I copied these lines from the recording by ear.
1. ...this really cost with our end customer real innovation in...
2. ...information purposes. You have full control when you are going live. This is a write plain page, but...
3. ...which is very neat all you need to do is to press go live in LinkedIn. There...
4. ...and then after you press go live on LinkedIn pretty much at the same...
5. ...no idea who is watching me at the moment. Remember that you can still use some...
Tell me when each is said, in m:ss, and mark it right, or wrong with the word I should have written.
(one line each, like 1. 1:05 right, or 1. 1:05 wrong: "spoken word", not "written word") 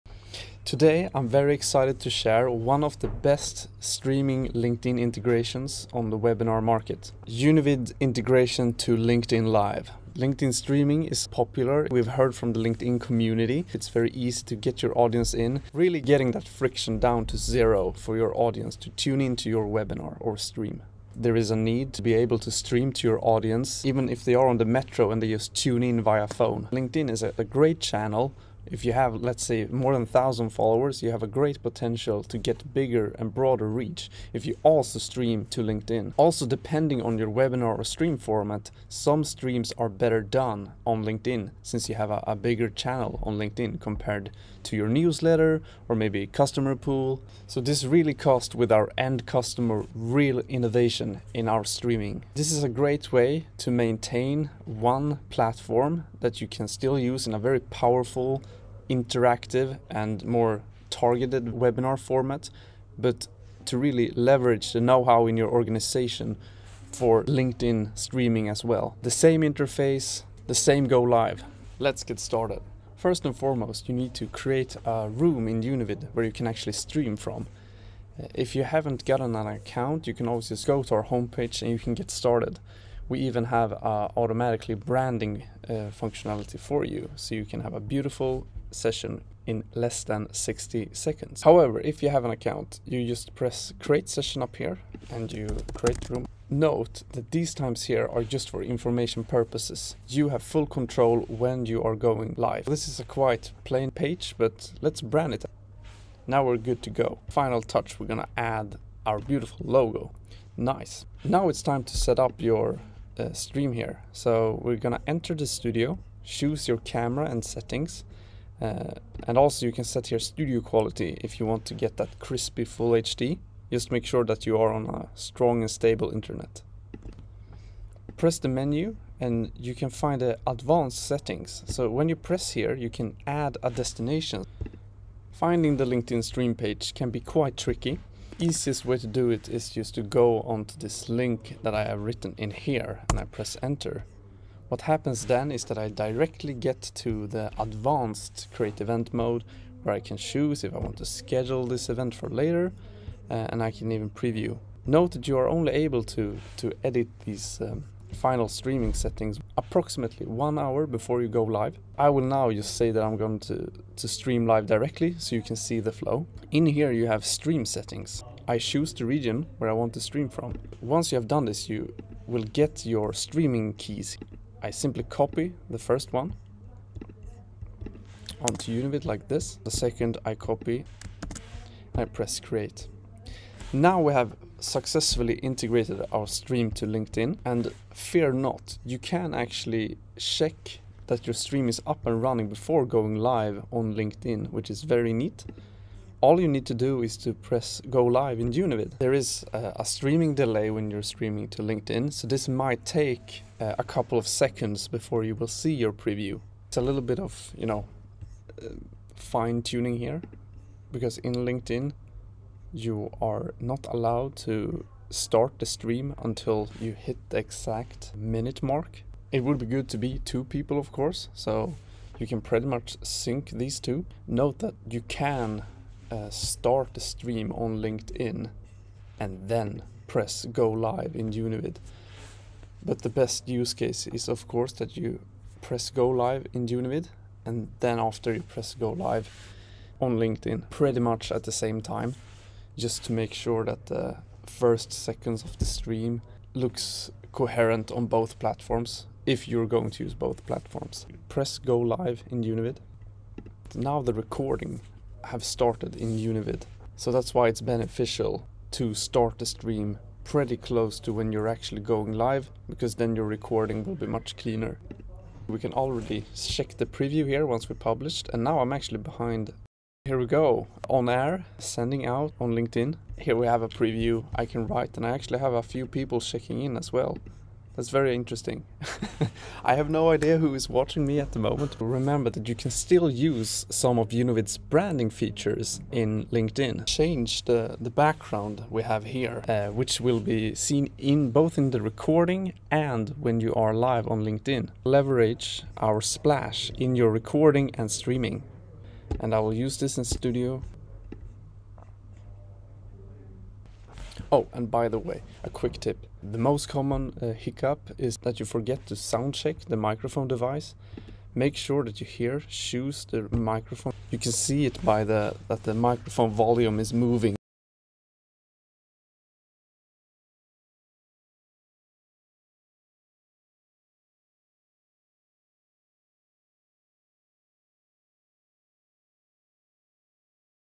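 1. 0:47 right
2. 1:38 wrong: "quite", not "write"
3. 3:14 wrong: "Univid", not "LinkedIn"
4. 3:57 right
5. 4:39 right.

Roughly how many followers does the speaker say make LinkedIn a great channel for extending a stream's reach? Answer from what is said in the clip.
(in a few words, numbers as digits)
1,000.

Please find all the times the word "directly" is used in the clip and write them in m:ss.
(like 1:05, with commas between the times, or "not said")
2:25, 2:44.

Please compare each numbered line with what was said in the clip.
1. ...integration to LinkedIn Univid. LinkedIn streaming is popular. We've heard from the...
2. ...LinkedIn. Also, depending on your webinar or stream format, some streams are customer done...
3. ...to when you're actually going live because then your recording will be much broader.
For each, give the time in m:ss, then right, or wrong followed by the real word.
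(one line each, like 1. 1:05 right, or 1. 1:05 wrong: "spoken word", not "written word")
1. 0:07 wrong: "Live", not "Univid"
2. 0:35 wrong: "better", not "customer"
3. 4:21 wrong: "cleaner", not "broader".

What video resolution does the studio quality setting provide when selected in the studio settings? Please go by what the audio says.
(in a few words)
full HD.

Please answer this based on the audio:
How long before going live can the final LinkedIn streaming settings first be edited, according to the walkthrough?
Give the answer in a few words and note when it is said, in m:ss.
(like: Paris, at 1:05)
1 hour, at 2:40.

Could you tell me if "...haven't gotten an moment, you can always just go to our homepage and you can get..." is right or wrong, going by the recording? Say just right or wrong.
wrong.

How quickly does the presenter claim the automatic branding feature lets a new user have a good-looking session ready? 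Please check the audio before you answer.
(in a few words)
less than 60 seconds.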